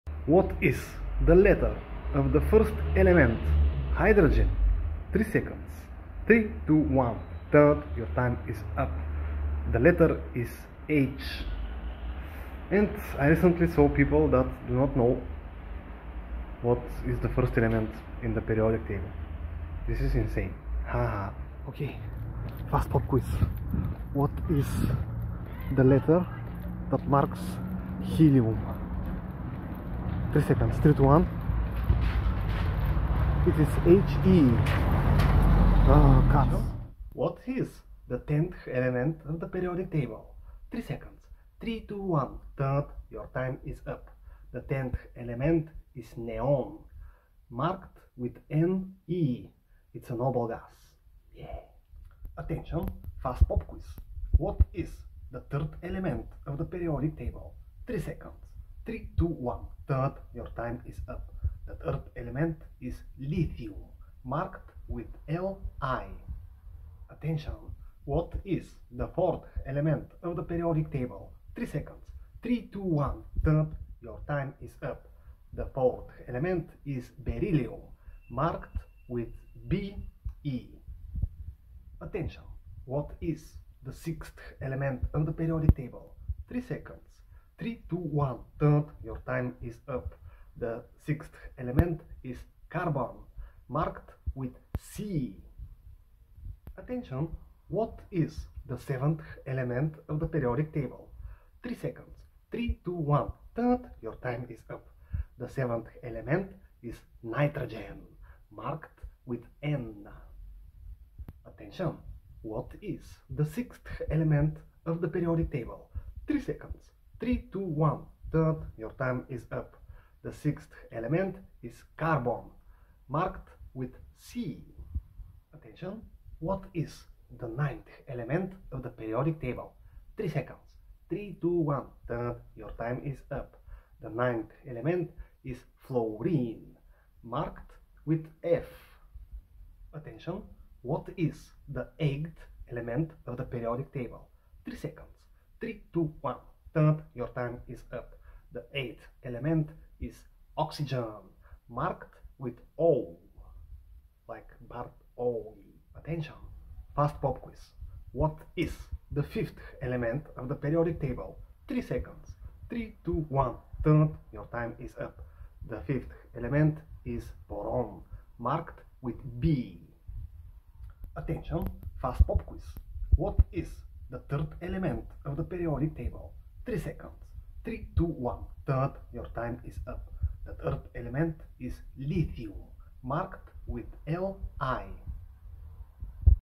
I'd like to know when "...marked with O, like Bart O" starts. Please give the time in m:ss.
2:31.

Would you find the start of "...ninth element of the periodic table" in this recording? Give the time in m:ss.
2:07.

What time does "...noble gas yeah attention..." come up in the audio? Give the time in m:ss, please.
0:50.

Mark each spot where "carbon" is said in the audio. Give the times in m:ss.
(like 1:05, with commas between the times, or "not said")
1:32, 2:01.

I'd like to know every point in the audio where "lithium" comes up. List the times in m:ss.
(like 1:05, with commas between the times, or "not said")
1:03, 3:01.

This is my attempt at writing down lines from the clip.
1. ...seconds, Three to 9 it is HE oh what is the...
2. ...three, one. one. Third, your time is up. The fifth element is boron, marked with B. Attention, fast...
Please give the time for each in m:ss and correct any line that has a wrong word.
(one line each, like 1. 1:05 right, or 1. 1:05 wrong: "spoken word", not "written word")
1. 0:30 wrong: "1", not "9"
2. 2:43 wrong: "two", not "three".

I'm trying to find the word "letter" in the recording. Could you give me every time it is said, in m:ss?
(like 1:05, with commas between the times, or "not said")
0:01, 0:09, 0:25.